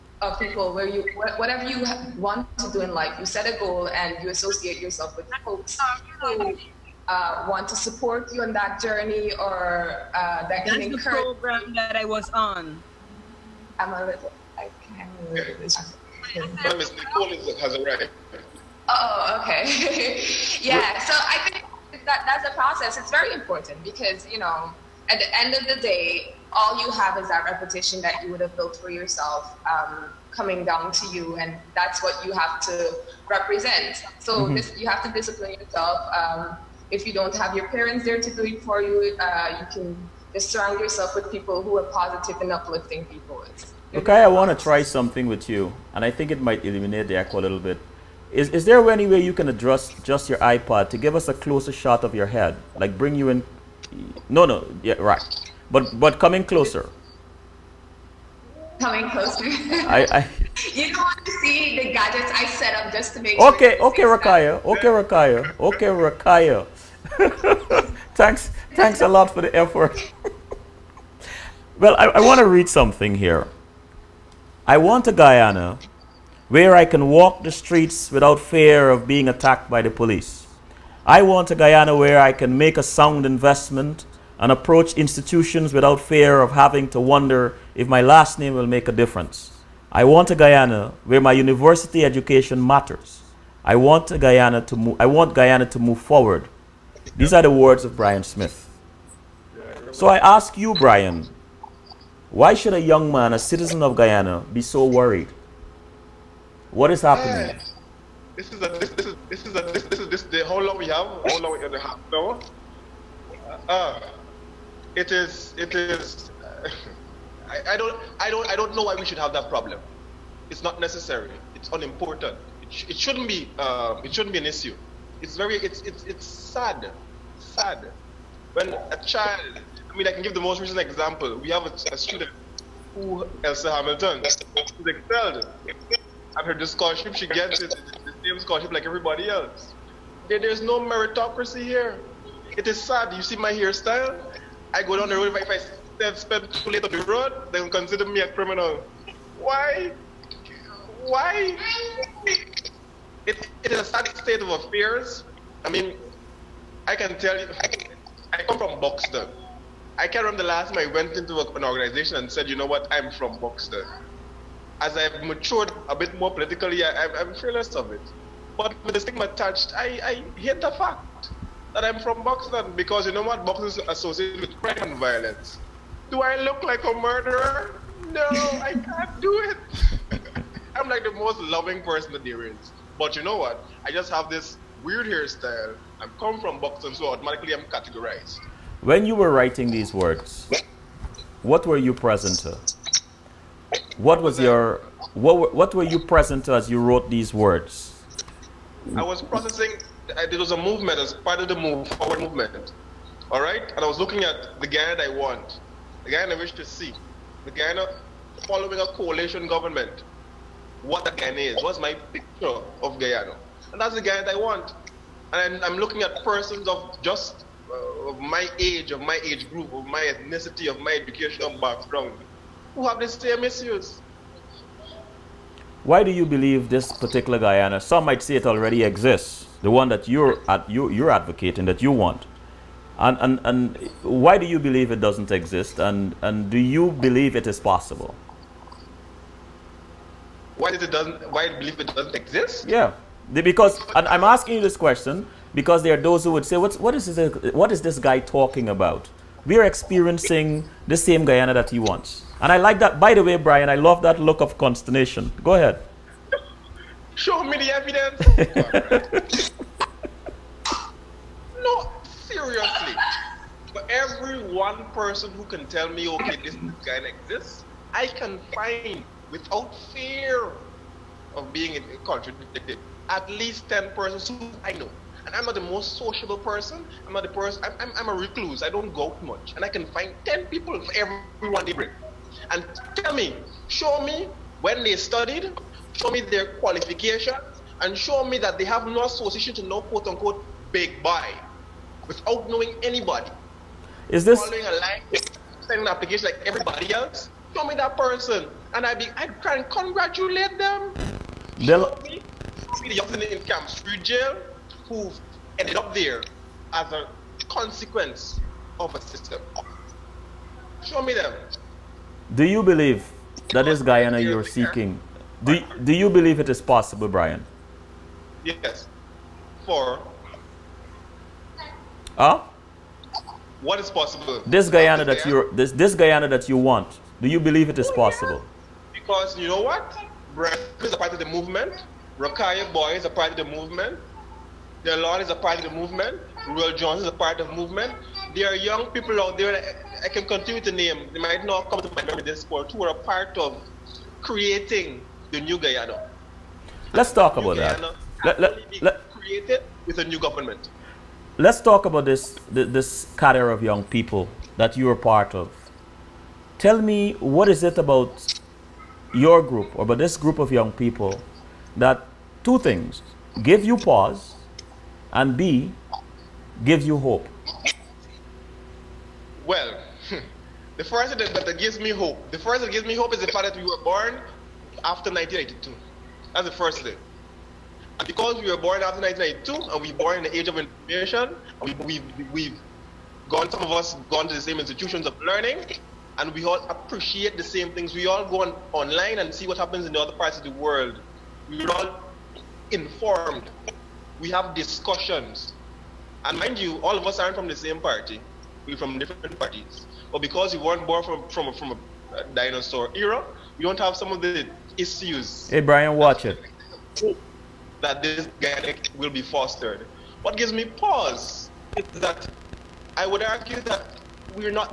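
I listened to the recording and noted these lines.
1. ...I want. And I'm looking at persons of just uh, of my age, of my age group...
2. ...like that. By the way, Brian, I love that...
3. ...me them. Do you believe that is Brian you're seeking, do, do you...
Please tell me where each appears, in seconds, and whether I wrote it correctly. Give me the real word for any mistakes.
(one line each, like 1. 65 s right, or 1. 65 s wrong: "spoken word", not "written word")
1. 214 s right
2. 252 s right
3. 311 s wrong: "Guyana", not "Brian".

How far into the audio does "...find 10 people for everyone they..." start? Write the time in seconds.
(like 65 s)
279 s.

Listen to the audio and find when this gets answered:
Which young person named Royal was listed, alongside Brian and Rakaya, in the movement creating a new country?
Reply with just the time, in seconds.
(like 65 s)
336 s.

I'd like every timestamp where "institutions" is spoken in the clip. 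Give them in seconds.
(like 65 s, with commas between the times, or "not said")
84 s, 384 s.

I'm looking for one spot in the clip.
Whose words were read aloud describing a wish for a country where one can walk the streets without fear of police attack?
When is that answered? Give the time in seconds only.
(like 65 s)
97 s.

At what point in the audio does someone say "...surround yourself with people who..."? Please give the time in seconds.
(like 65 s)
40 s.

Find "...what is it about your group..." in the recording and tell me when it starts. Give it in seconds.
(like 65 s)
357 s.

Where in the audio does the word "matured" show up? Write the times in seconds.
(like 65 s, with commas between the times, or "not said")
165 s.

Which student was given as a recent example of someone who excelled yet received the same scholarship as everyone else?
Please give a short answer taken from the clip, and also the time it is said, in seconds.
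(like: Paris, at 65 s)
Elsa Hamilton, at 133 s.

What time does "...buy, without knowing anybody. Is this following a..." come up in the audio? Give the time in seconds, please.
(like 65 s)
291 s.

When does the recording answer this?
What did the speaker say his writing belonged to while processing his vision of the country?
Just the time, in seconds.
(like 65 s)
201 s.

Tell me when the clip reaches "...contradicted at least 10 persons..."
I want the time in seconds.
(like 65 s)
272 s.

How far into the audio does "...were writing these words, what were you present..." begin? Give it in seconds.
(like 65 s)
189 s.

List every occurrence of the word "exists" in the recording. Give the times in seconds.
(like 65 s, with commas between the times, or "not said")
228 s, 235 s, 242 s, 267 s.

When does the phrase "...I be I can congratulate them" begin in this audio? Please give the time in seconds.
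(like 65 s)
298 s.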